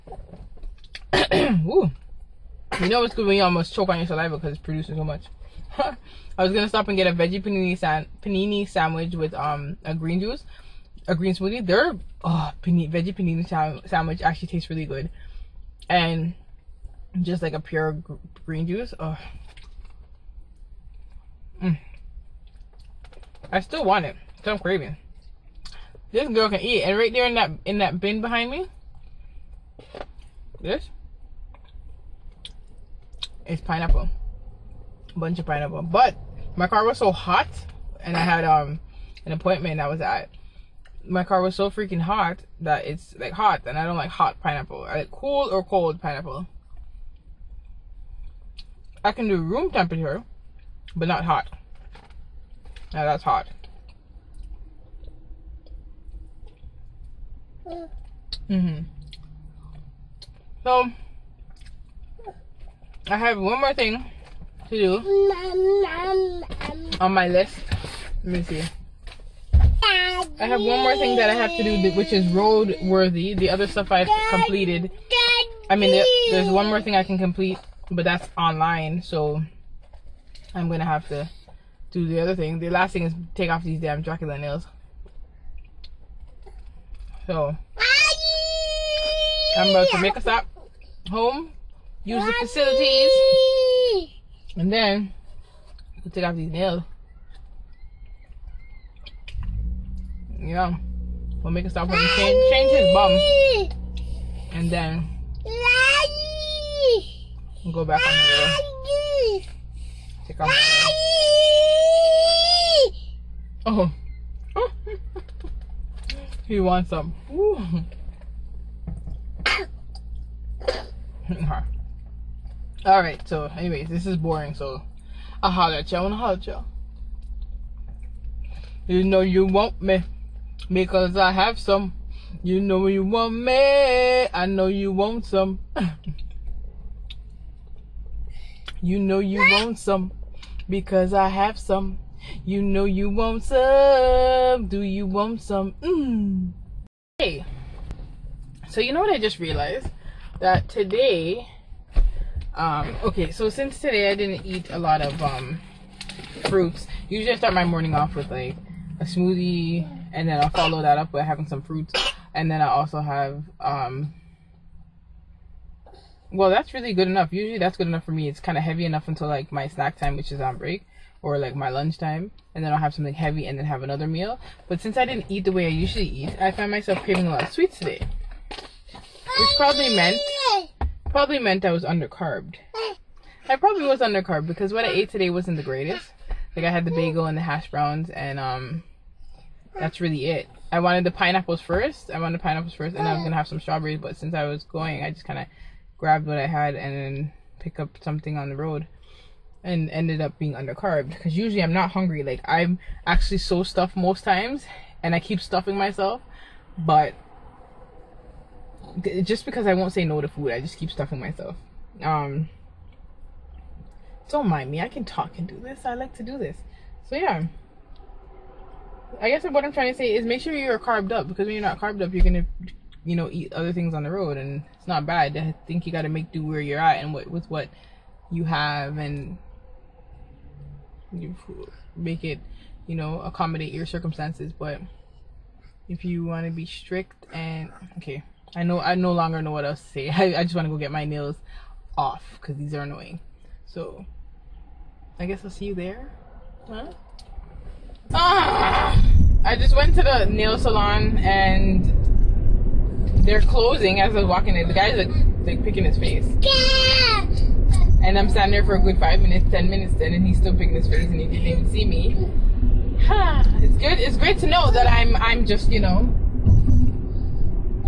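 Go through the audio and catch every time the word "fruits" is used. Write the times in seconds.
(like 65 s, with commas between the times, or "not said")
156 s, 161 s.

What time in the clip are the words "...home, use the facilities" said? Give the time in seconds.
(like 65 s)
91 s.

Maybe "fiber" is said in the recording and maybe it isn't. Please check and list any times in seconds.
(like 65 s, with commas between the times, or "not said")
not said.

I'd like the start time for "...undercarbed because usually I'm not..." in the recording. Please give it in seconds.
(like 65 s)
200 s.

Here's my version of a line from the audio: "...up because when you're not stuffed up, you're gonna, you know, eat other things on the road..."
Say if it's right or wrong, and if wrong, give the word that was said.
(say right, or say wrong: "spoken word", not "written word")
wrong: "carbed", not "stuffed".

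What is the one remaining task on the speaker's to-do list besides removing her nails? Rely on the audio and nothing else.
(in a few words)
road worthy.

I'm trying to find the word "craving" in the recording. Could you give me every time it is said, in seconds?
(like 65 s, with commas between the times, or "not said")
24 s, 177 s.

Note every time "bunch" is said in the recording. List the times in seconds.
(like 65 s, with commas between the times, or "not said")
35 s.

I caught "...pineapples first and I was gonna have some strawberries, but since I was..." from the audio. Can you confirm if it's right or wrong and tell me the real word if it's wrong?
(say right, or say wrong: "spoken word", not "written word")
right.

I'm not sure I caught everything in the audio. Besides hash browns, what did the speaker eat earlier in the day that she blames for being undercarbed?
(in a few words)
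bagel.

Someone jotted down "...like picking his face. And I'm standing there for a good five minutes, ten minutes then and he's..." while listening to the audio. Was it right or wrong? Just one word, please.
right.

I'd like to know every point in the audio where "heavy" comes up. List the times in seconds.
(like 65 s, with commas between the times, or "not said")
168 s, 173 s.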